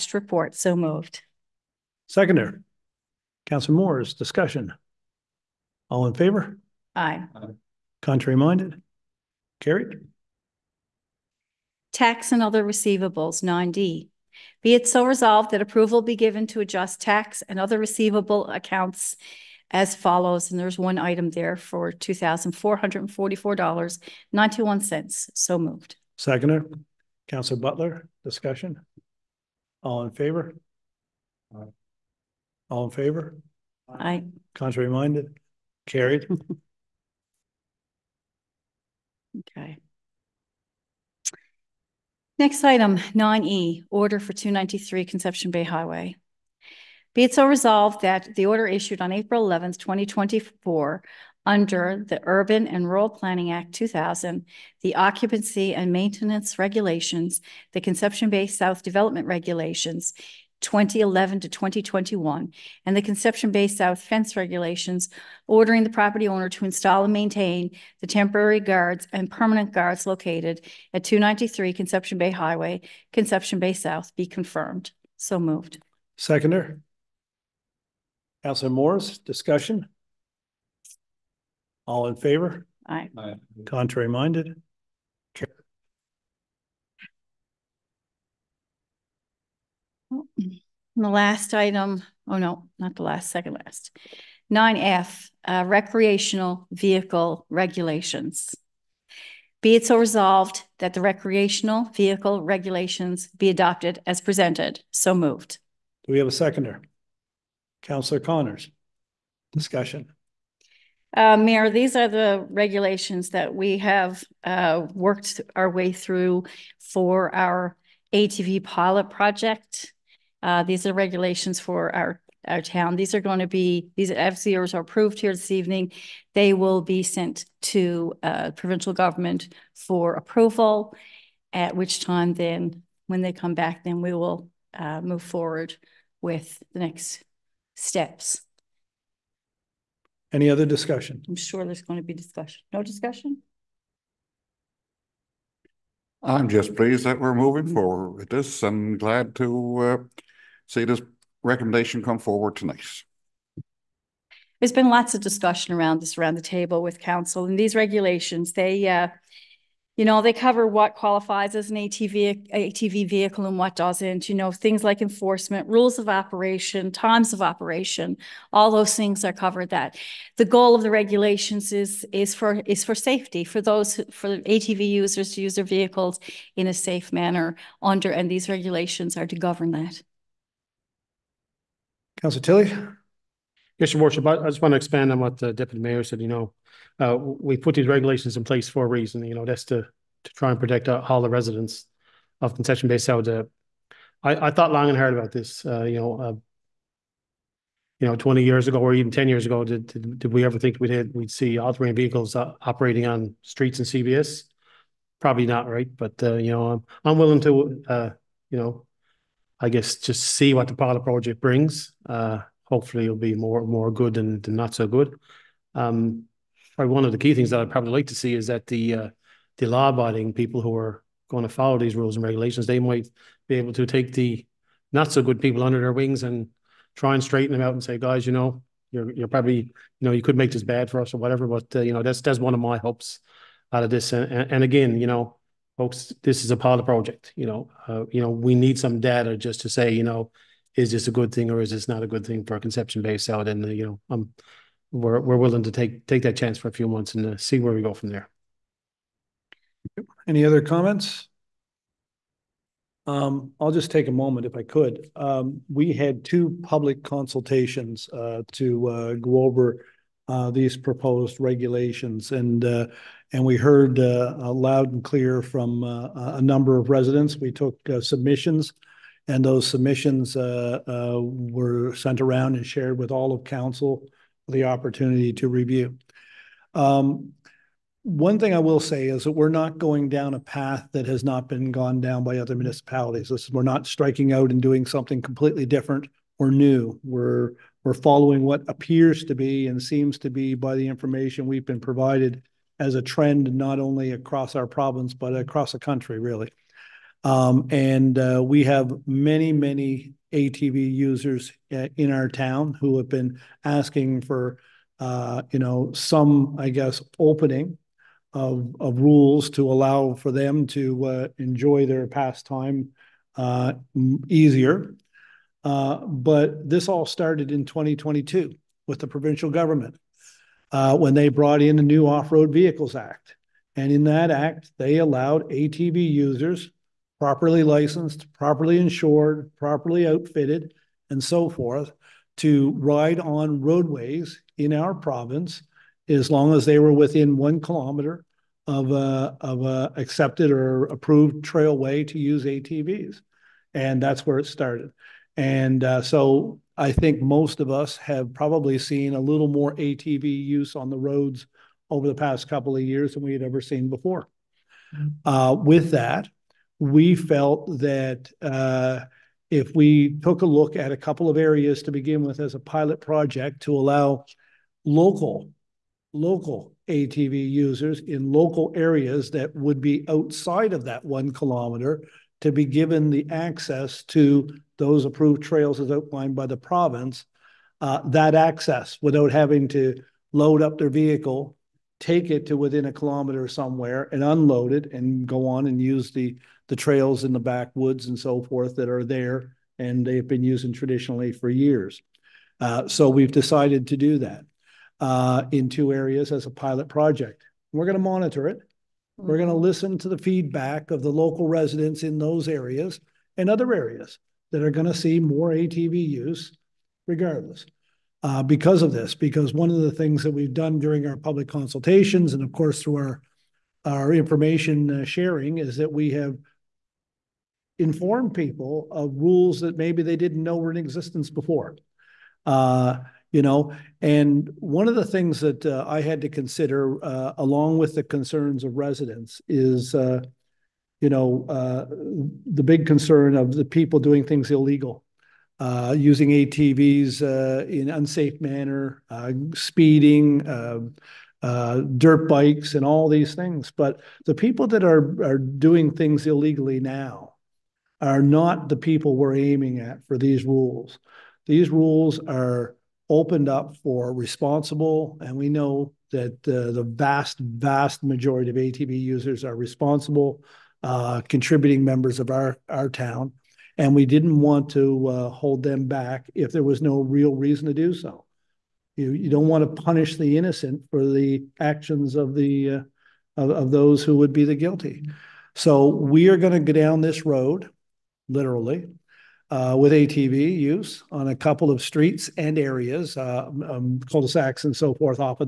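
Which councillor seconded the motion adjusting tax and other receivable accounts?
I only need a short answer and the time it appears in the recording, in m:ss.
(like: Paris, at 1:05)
Councillor Butler, at 0:27.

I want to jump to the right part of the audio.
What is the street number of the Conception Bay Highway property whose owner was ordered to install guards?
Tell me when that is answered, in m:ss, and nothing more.
0:44.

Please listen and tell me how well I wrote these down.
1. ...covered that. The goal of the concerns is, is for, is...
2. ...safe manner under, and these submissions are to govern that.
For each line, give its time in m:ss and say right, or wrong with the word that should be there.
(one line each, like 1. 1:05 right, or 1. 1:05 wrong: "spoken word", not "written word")
1. 2:49 wrong: "regulations", not "concerns"
2. 2:56 wrong: "regulations", not "submissions".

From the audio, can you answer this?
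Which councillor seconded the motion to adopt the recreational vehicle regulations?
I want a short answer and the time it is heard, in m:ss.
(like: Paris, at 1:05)
Councillor Connors, at 1:47.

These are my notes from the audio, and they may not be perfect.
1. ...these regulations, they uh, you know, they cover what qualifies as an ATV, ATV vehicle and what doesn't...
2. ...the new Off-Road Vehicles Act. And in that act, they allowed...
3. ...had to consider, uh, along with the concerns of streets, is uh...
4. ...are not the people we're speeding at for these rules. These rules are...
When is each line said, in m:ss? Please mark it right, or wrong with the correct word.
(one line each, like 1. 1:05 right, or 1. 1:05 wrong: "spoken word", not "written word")
1. 2:37 right
2. 5:21 right
3. 7:06 wrong: "residents", not "streets"
4. 7:28 wrong: "aiming", not "speeding".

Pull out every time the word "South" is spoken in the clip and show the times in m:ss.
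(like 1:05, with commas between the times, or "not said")
0:58, 1:03, 1:13, 3:12, 4:03.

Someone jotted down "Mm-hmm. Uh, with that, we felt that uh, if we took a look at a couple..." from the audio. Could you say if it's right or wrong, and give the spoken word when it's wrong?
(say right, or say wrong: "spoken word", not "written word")
right.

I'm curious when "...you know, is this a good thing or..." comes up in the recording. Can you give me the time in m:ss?
3:59.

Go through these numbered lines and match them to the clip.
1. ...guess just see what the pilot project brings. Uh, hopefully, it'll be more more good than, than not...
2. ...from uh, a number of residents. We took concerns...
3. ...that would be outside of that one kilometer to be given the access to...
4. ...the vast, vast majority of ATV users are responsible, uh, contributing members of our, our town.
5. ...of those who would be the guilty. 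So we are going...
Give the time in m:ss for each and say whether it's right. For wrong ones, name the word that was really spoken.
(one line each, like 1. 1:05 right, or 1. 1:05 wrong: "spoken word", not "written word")
1. 3:29 right
2. 4:25 wrong: "submissions", not "concerns"
3. 6:09 right
4. 7:36 right
5. 7:53 right.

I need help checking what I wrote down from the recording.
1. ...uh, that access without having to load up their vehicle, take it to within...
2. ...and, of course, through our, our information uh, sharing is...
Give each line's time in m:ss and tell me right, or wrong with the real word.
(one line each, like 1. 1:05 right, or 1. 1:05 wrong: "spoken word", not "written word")
1. 6:17 right
2. 6:52 right.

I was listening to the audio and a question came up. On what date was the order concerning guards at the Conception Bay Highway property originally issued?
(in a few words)
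April 11, 2024.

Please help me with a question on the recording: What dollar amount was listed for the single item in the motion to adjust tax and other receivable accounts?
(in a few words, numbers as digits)
$2,444.91.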